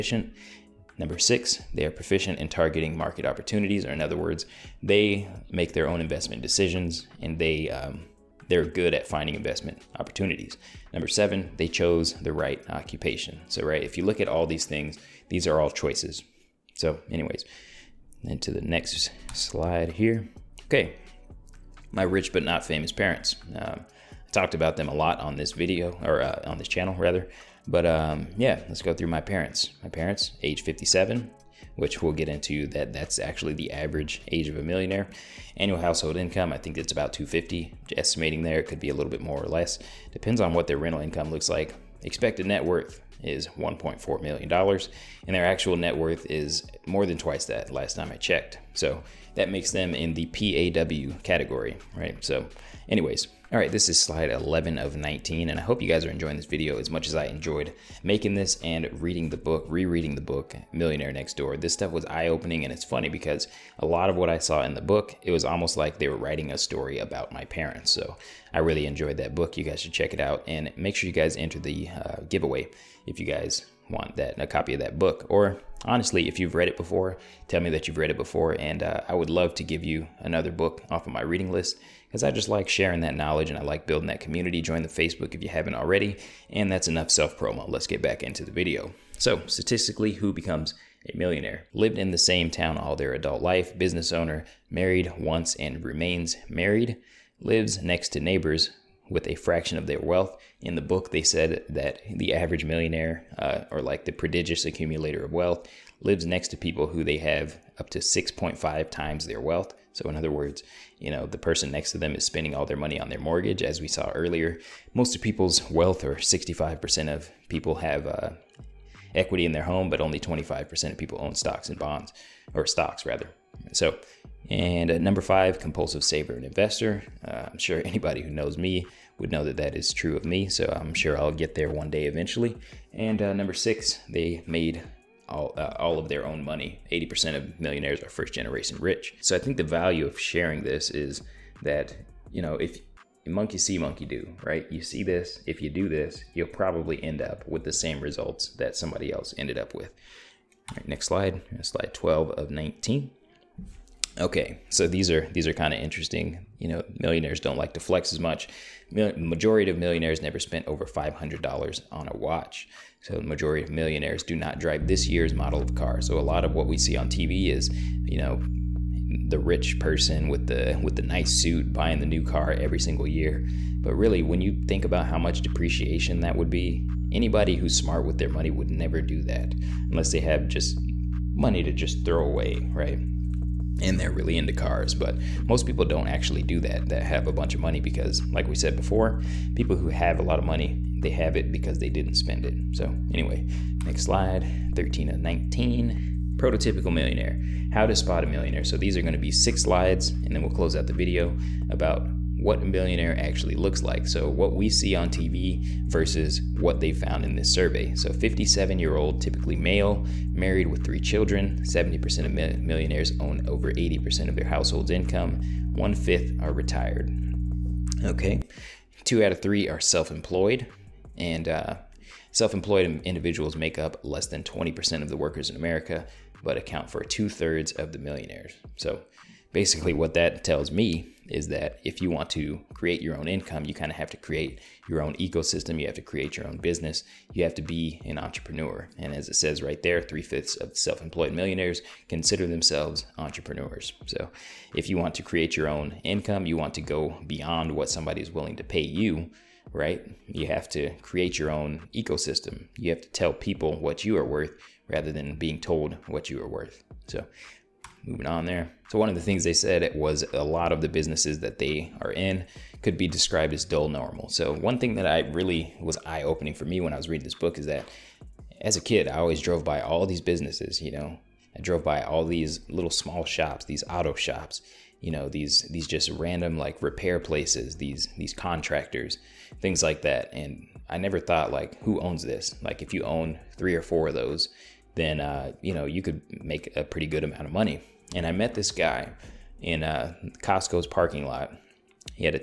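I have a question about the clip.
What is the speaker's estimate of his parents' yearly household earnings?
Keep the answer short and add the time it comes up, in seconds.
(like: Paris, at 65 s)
250, at 36 s.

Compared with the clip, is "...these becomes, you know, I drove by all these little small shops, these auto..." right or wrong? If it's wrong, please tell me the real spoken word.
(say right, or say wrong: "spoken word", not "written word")
wrong: "businesses", not "becomes".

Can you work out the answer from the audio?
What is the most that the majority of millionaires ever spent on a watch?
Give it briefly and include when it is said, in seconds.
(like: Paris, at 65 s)
$500, at 160 s.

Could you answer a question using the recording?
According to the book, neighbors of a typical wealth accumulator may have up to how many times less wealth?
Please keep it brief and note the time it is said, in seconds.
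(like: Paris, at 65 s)
6.5 times, at 107 s.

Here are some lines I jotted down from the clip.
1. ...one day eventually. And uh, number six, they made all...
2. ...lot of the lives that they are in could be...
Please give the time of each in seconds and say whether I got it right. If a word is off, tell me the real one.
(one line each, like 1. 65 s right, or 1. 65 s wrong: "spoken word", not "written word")
1. 131 s right
2. 260 s wrong: "businesses", not "lives".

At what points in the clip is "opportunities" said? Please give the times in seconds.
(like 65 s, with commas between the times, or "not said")
3 s, 9 s.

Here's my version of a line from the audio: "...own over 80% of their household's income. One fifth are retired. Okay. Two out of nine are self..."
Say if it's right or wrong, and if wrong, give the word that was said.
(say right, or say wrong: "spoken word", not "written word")
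wrong: "three", not "nine".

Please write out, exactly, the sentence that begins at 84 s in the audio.
Join the Facebook if you haven't already.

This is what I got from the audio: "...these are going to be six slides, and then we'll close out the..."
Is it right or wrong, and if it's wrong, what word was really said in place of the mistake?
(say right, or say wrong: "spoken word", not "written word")
right.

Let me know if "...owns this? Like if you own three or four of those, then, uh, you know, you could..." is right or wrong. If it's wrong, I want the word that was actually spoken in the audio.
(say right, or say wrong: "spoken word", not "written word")
right.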